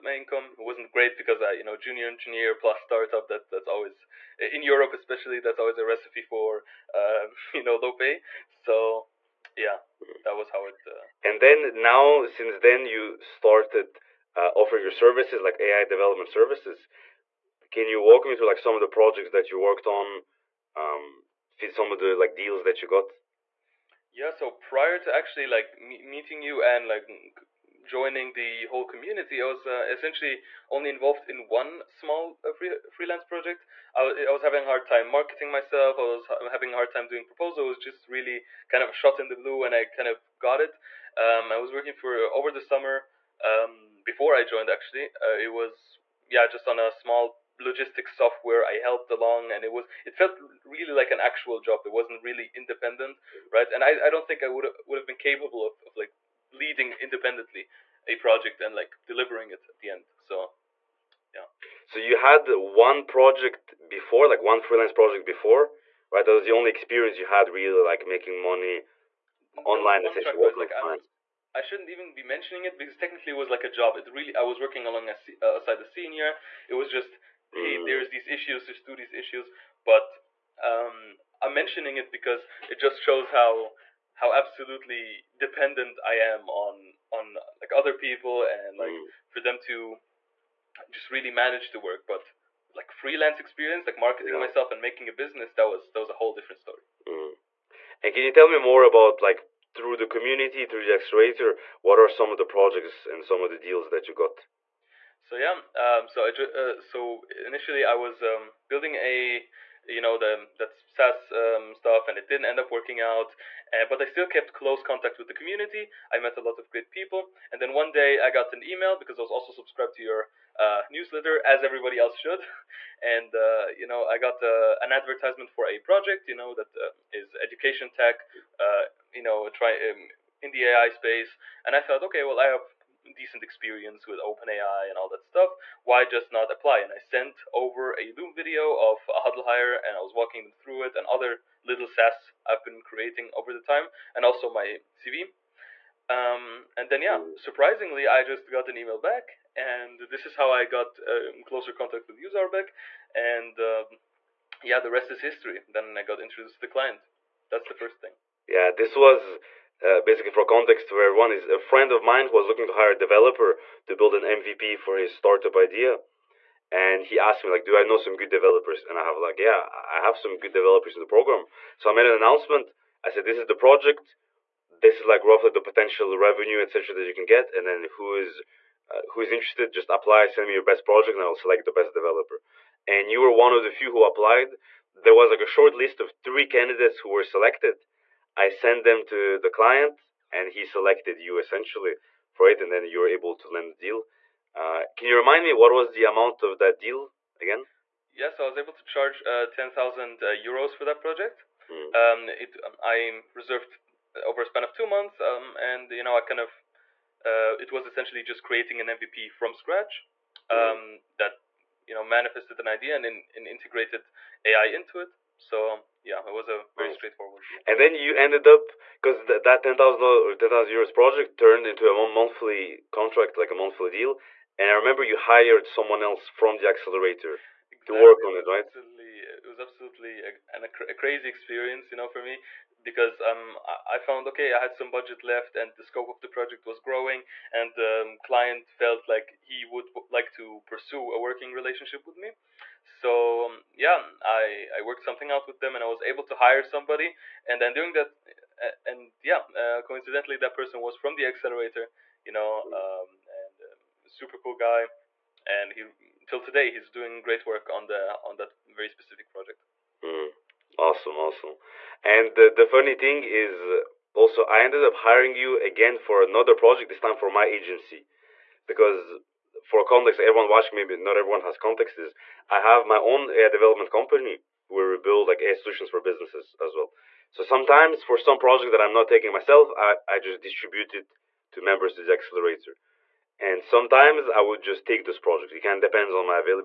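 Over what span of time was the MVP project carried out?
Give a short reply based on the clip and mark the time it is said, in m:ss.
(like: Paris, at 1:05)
two months, at 3:24.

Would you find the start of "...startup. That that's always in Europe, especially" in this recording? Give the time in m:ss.
0:02.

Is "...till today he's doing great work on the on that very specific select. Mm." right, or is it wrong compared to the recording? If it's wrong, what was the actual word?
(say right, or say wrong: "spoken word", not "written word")
wrong: "project", not "select".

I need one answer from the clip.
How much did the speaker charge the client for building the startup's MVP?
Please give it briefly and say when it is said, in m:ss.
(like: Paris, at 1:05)
10,000 euros, at 3:19.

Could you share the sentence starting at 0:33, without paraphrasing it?
I, w- I was having a hard time marketing myself.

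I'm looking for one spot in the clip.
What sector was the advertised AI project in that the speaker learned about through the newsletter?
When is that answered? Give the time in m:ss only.
2:07.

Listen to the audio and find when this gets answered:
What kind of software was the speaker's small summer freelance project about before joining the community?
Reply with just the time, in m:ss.
0:47.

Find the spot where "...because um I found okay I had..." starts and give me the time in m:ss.
3:52.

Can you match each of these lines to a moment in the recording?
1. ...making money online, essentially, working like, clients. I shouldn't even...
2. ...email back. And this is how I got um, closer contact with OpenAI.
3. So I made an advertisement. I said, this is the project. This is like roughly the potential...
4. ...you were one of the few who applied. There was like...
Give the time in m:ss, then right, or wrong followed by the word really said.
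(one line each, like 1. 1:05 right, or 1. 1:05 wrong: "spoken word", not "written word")
1. 1:08 right
2. 2:28 wrong: "Zaurbek", not "OpenAI"
3. 2:51 wrong: "announcement", not "advertisement"
4. 3:03 right.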